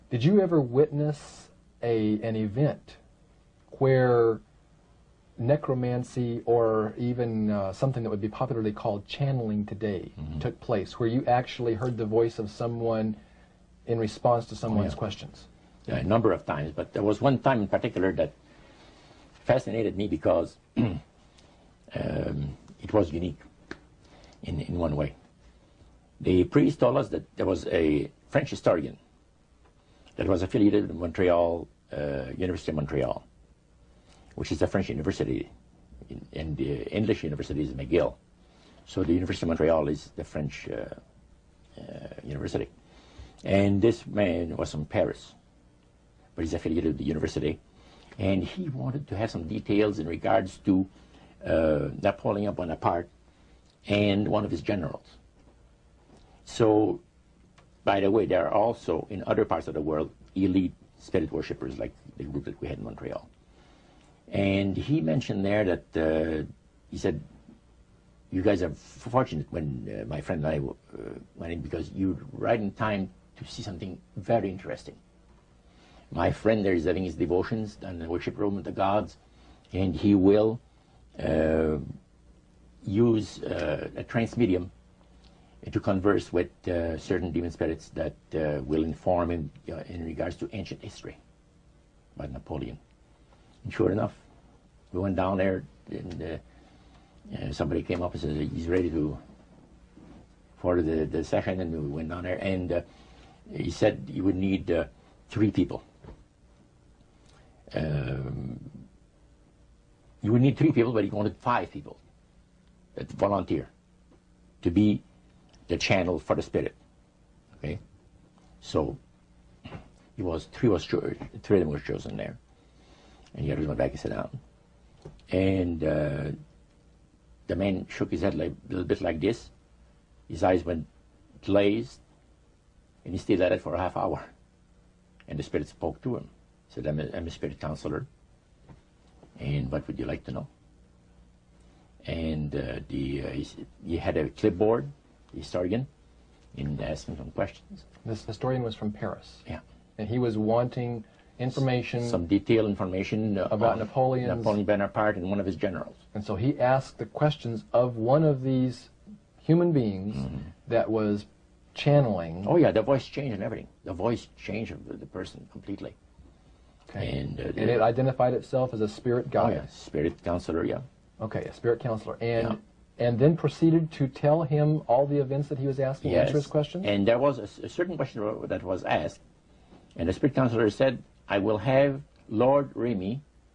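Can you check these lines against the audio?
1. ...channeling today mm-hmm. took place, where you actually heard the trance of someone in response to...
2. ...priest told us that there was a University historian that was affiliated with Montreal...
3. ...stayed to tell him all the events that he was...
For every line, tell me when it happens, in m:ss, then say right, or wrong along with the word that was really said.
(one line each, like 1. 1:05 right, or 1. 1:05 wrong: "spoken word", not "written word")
1. 0:09 wrong: "voice", not "trance"
2. 0:26 wrong: "French", not "University"
3. 2:53 wrong: "proceeded", not "stayed".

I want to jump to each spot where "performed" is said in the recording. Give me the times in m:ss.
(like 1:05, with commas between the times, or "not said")
not said.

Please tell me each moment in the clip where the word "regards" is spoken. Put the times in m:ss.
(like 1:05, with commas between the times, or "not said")
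0:50, 1:30.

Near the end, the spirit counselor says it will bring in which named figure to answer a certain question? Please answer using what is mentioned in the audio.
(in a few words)
Lord Remy.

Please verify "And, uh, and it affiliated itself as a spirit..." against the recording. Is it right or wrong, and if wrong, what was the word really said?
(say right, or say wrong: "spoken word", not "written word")
wrong: "identified", not "affiliated".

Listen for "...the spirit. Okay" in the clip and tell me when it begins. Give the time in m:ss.
1:56.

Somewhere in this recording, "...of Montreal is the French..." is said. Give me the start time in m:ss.
0:39.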